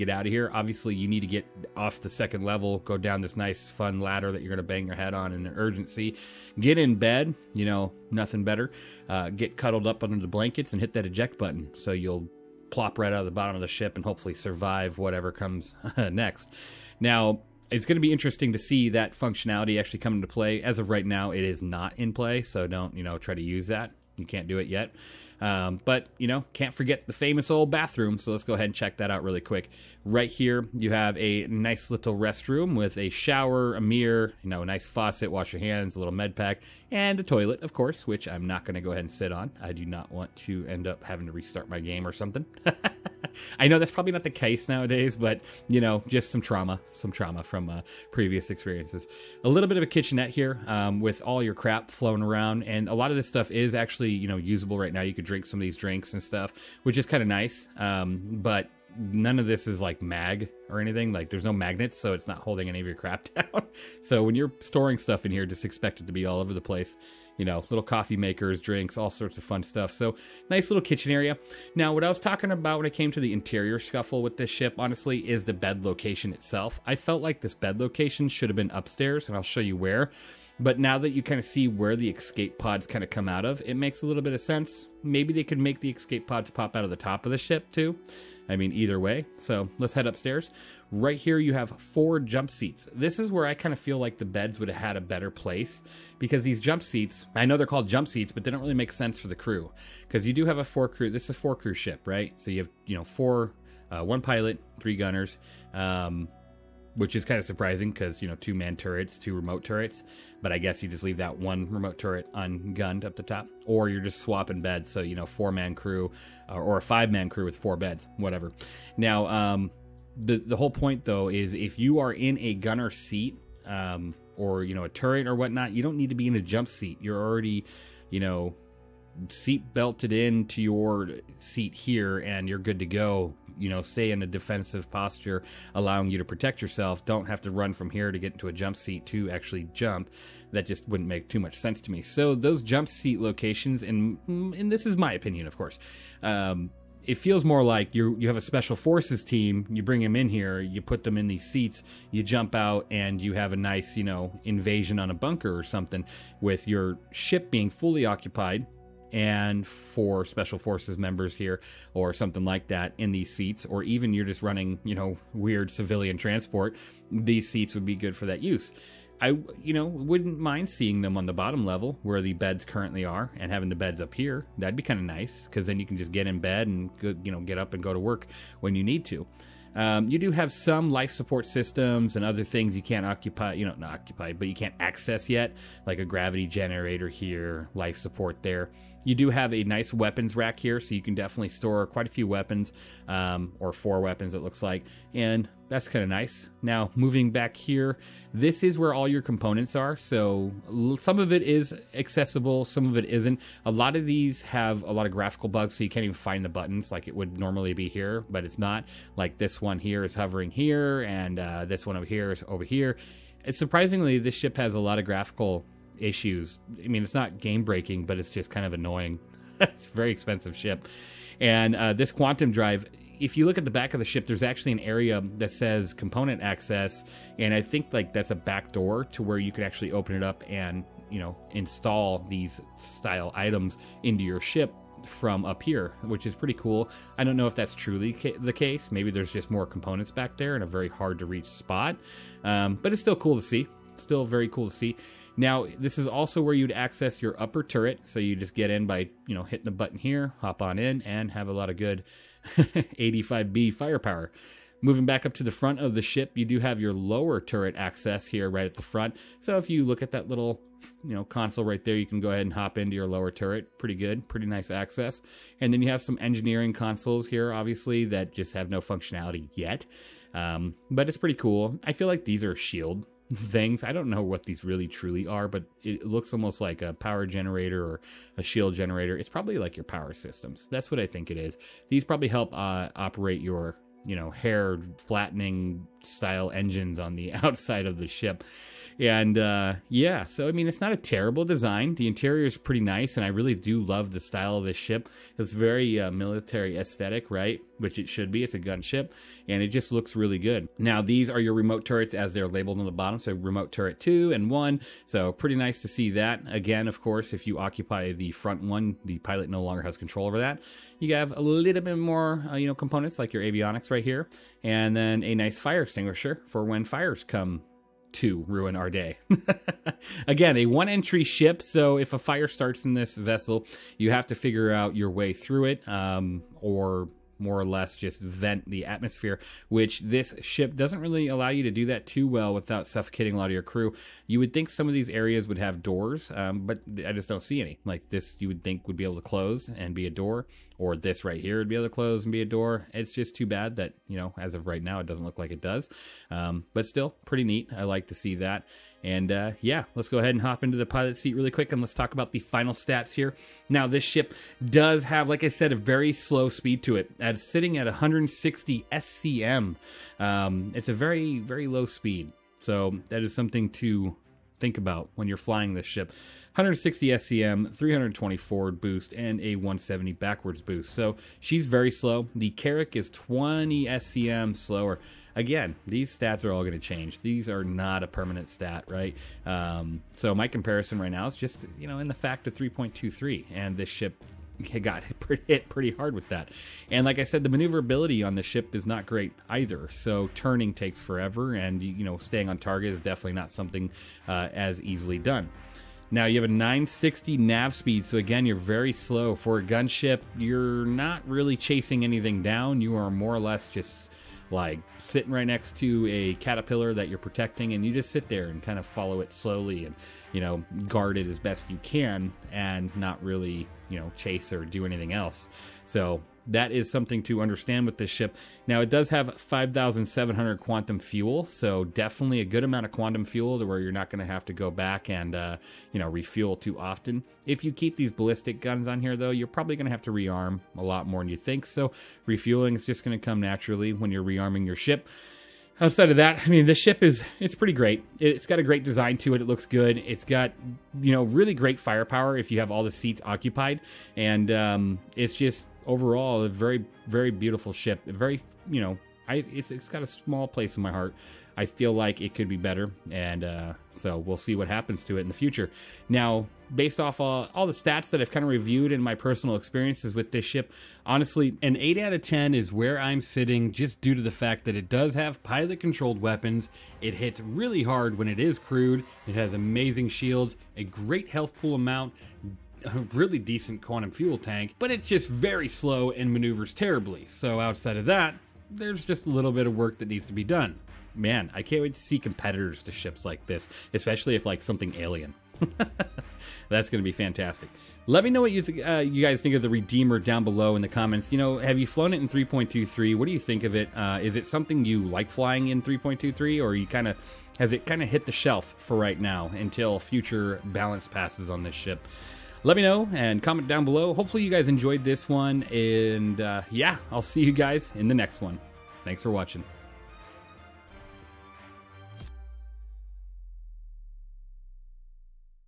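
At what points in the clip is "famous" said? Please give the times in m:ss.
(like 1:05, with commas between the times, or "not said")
0:27.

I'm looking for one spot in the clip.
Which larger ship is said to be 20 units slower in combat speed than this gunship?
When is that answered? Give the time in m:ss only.
6:12.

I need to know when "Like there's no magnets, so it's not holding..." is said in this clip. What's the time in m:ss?
1:01.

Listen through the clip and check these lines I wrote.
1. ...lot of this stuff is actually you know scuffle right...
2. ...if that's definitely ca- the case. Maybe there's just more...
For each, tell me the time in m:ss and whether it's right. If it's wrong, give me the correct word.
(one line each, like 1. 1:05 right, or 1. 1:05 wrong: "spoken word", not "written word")
1. 0:52 wrong: "usable", not "scuffle"
2. 3:57 wrong: "truly", not "definitely".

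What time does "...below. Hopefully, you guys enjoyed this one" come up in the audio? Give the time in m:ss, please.
8:23.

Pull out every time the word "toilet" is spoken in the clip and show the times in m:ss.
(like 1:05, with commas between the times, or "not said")
0:37.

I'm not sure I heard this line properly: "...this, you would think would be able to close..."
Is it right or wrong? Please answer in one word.
right.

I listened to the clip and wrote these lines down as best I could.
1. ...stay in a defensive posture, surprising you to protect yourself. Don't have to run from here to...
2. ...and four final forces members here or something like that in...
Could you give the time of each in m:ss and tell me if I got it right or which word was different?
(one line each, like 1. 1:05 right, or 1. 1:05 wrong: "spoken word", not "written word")
1. 2:13 wrong: "allowing", not "surprising"
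2. 2:39 wrong: "special", not "final".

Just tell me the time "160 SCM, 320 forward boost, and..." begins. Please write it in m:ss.
6:06.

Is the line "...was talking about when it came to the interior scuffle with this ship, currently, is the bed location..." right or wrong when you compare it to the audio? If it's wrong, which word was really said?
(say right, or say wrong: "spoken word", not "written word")
wrong: "honestly", not "currently".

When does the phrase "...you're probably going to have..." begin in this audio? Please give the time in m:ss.
7:09.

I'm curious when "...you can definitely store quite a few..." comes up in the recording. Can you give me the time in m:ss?
3:10.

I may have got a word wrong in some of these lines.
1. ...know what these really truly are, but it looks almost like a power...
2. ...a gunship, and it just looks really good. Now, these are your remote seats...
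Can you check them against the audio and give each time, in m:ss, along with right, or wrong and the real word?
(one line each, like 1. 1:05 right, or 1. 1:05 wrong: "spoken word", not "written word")
1. 4:34 right
2. 4:58 wrong: "turrets", not "seats".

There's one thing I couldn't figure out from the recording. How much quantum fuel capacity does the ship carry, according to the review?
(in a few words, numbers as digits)
5,700.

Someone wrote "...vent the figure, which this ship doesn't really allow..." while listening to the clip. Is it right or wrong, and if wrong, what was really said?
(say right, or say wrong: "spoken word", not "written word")
wrong: "atmosphere", not "figure".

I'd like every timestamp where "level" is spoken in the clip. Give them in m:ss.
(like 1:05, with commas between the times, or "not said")
0:02, 2:51.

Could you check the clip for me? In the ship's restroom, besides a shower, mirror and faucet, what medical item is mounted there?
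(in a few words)
med pack.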